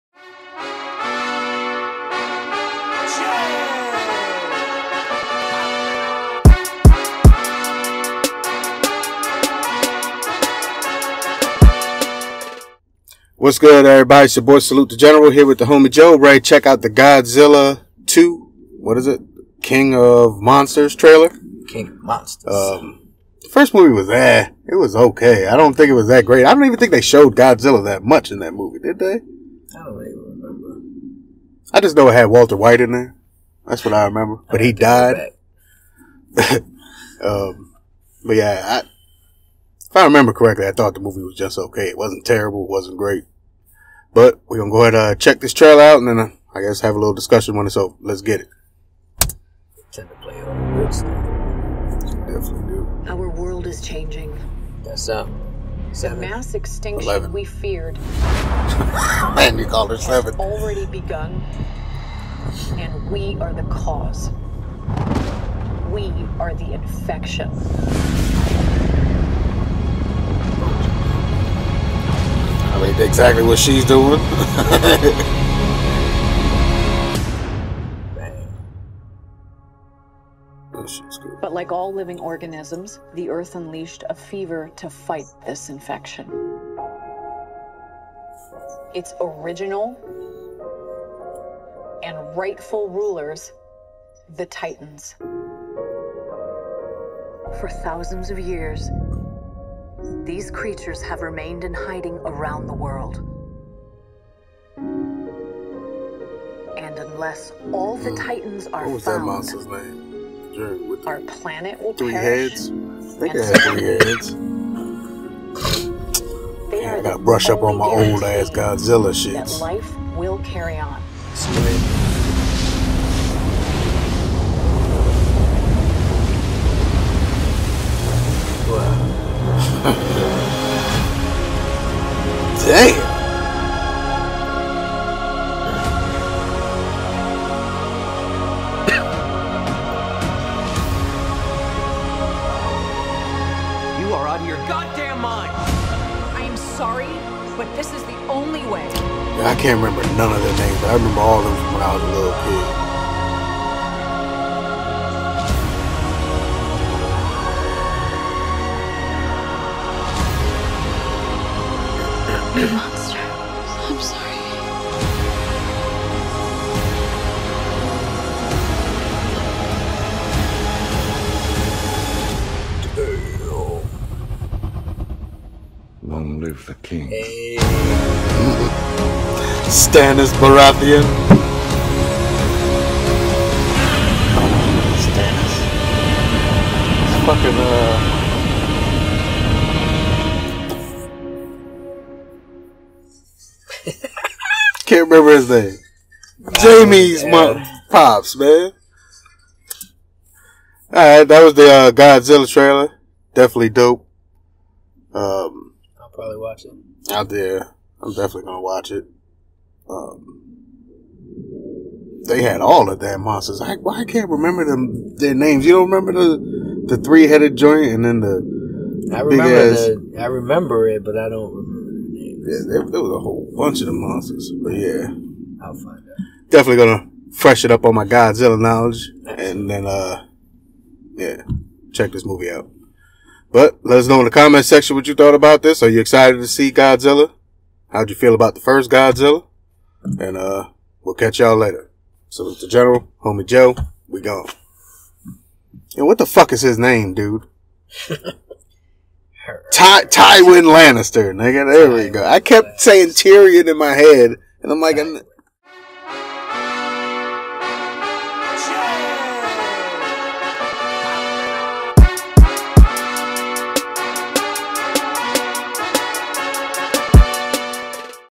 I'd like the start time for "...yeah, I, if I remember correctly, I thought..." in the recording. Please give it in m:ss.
0:38.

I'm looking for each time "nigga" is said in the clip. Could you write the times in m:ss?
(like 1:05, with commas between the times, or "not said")
4:11.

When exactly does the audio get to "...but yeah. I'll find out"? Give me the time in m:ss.
3:44.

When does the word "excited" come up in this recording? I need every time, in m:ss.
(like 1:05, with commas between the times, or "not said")
3:55.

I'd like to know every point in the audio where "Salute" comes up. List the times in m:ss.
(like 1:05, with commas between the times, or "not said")
0:14, 4:02.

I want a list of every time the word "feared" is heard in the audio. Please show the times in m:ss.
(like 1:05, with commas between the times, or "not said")
0:57.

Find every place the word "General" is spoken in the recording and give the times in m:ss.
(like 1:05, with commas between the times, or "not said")
0:14, 4:02.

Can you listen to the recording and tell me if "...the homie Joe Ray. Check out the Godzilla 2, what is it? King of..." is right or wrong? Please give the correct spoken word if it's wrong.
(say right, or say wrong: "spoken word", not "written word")
right.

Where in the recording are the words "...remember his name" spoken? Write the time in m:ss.
3:15.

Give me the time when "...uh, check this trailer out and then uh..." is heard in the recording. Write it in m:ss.
0:45.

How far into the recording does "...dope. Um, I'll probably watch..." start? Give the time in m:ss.
3:23.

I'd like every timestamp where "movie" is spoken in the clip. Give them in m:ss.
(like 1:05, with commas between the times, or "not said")
0:23, 0:28, 0:41, 3:52.